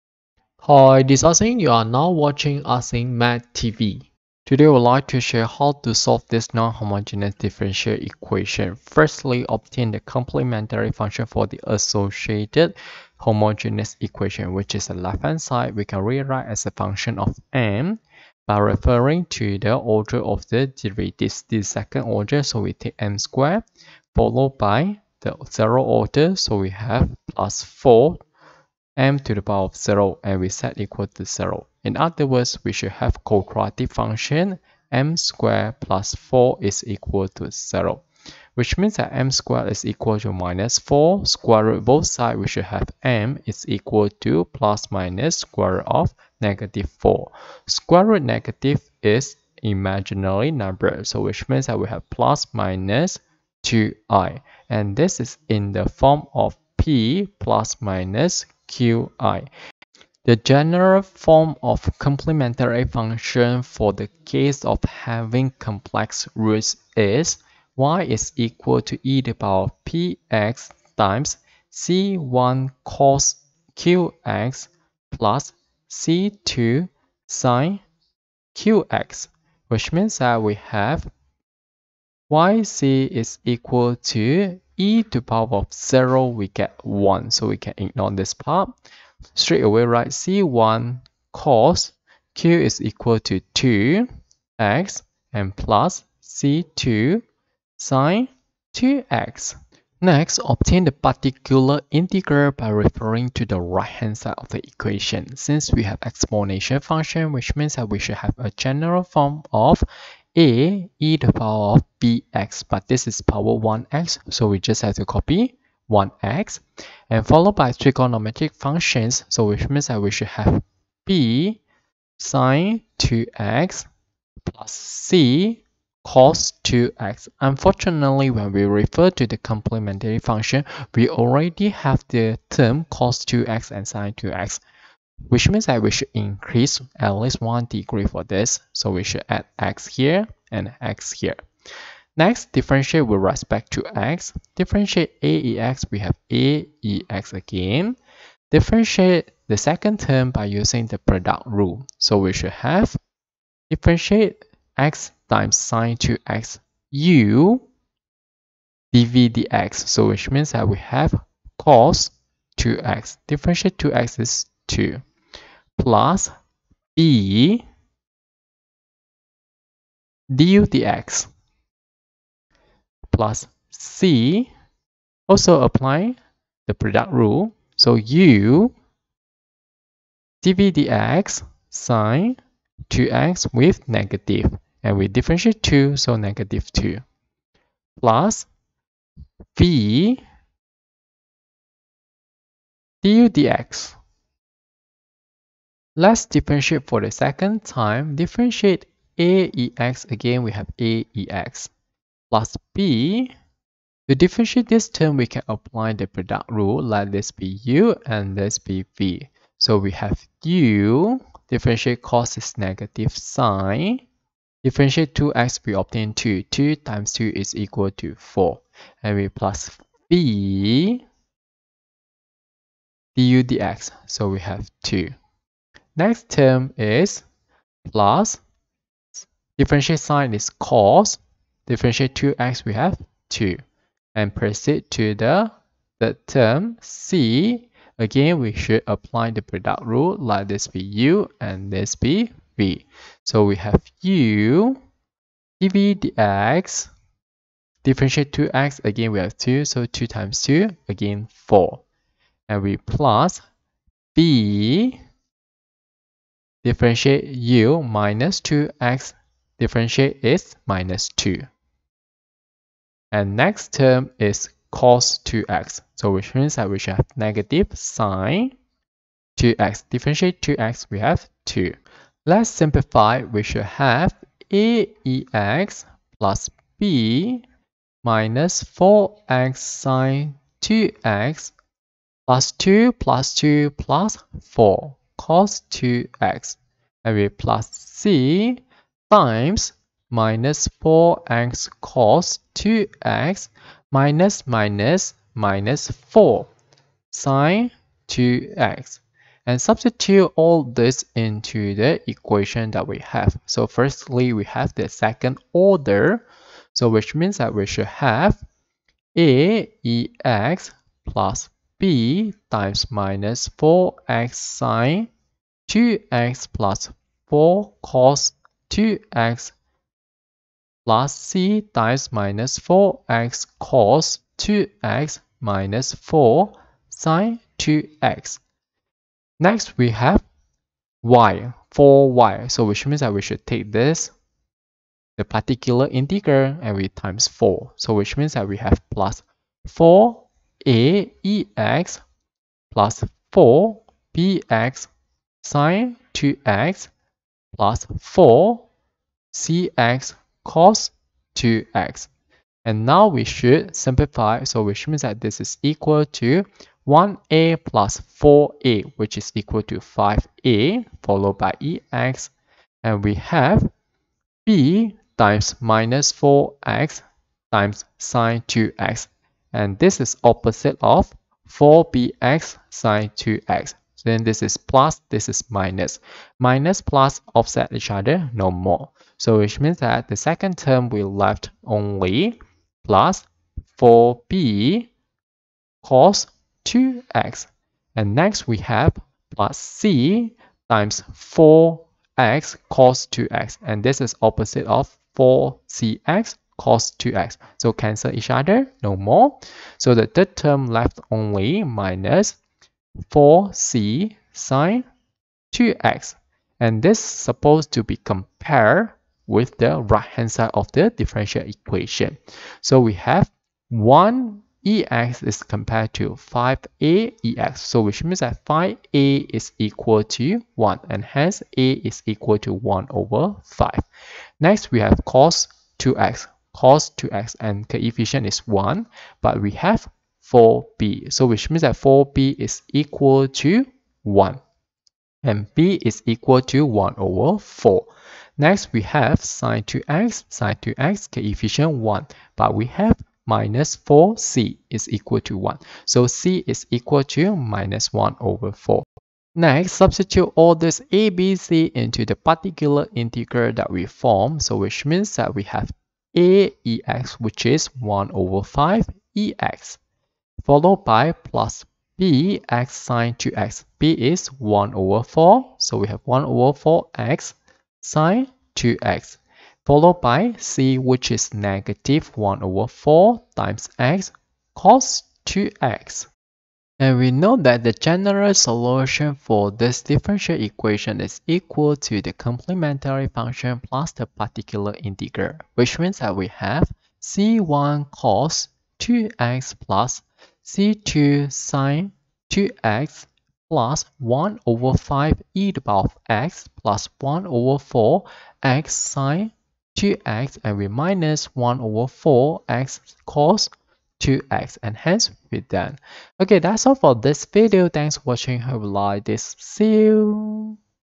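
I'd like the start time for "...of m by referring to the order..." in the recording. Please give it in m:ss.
0:17.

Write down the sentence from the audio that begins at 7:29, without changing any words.
Next, substitute all this ABC into the particular integral that we form.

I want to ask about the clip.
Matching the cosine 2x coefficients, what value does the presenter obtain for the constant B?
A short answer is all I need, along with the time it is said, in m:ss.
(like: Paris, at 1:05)
1/4, at 7:15.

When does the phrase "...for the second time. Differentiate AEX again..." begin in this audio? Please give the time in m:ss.
3:16.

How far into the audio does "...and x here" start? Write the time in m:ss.
2:20.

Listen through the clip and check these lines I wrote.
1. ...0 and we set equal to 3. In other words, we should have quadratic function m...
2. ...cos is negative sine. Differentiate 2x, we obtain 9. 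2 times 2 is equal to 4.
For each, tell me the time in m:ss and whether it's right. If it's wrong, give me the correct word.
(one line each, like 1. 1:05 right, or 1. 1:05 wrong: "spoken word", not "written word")
1. 0:29 wrong: "0", not "3"
2. 3:32 wrong: "2", not "9".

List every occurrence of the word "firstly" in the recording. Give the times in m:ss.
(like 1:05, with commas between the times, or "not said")
0:08, 5:03.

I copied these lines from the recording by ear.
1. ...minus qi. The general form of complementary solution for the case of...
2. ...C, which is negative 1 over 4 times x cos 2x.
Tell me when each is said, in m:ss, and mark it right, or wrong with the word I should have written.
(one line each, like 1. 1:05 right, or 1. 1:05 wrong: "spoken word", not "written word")
1. 0:57 wrong: "function", not "solution"
2. 7:50 right.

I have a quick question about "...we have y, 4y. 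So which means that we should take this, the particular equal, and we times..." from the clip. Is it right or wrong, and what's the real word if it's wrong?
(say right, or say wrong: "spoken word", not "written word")
wrong: "integral", not "equal".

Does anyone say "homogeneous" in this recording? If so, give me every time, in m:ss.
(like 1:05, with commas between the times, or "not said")
0:06, 0:13.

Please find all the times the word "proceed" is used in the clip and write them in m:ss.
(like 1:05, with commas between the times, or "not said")
3:54.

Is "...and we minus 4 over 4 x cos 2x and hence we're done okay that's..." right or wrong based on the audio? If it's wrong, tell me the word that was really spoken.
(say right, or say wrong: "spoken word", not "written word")
wrong: "1", not "4".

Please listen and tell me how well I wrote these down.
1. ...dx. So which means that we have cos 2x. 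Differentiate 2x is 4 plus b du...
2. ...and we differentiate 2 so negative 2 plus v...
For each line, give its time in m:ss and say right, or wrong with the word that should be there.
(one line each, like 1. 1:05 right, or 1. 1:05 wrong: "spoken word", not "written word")
1. 2:39 wrong: "2", not "4"
2. 3:04 right.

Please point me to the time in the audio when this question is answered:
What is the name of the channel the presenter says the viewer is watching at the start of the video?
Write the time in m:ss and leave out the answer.
0:02.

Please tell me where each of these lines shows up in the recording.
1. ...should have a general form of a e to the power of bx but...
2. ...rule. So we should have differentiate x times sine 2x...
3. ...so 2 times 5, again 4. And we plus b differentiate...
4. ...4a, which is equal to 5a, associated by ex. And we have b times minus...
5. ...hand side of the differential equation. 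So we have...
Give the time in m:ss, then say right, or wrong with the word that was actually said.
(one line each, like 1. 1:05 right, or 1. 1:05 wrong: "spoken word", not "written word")
1. 1:47 right
2. 2:31 right
3. 4:09 wrong: "2", not "5"
4. 5:58 wrong: "followed", not "associated"
5. 6:50 right.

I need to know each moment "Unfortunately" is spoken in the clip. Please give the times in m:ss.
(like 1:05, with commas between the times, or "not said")
2:07.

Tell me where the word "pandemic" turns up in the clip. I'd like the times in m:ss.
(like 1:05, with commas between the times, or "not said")
not said.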